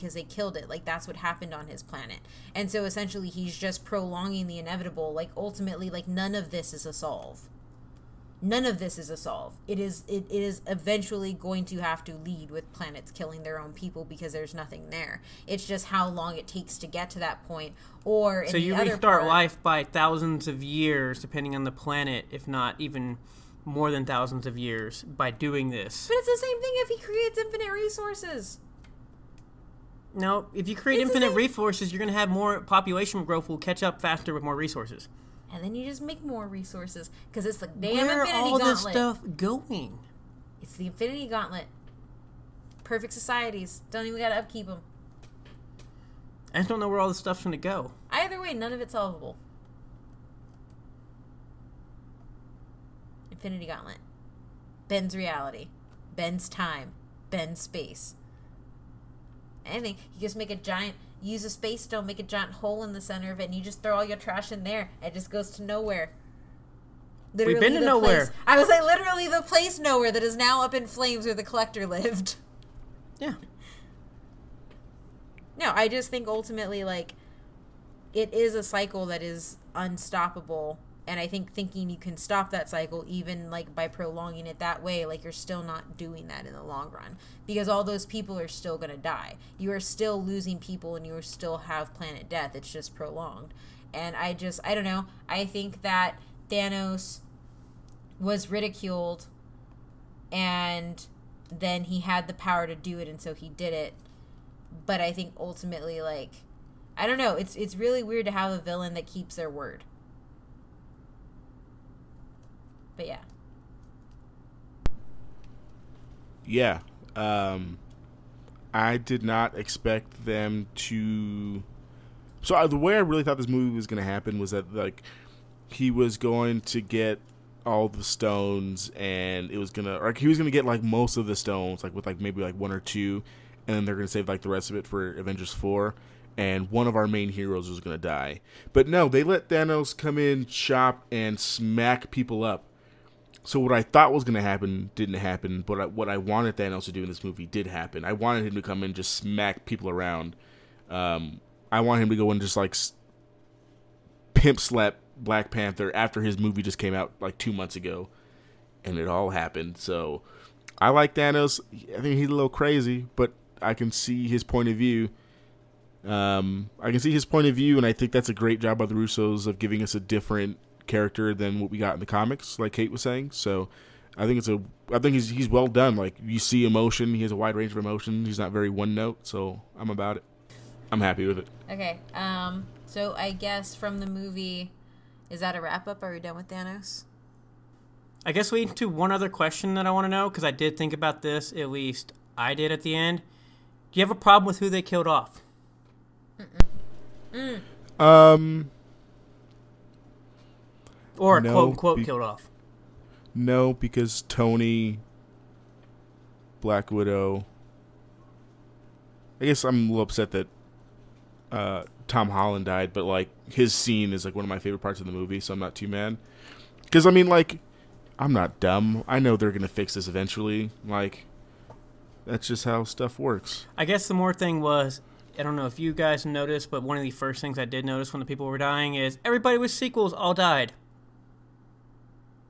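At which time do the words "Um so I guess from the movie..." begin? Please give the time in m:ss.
3:02.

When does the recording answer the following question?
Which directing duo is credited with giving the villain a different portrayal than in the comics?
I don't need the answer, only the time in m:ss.
2:48.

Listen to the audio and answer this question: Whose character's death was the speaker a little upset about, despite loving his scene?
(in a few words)
Tom Holland.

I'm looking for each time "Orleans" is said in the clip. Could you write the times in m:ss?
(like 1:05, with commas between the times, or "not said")
not said.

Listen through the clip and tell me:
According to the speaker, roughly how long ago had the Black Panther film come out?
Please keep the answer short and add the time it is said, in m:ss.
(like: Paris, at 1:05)
2 months, at 2:37.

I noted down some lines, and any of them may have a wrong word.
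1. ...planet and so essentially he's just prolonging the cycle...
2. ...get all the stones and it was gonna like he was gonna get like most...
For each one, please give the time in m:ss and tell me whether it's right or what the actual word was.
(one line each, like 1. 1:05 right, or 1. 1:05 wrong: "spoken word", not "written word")
1. 0:01 wrong: "inevitable", not "cycle"
2. 2:06 right.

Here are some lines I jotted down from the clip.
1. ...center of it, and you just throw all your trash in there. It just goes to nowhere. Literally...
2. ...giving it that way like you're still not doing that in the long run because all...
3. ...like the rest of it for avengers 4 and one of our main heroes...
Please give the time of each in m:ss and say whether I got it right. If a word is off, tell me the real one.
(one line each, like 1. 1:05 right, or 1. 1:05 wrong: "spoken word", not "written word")
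1. 1:02 right
2. 1:23 wrong: "prolonging", not "giving"
3. 2:14 right.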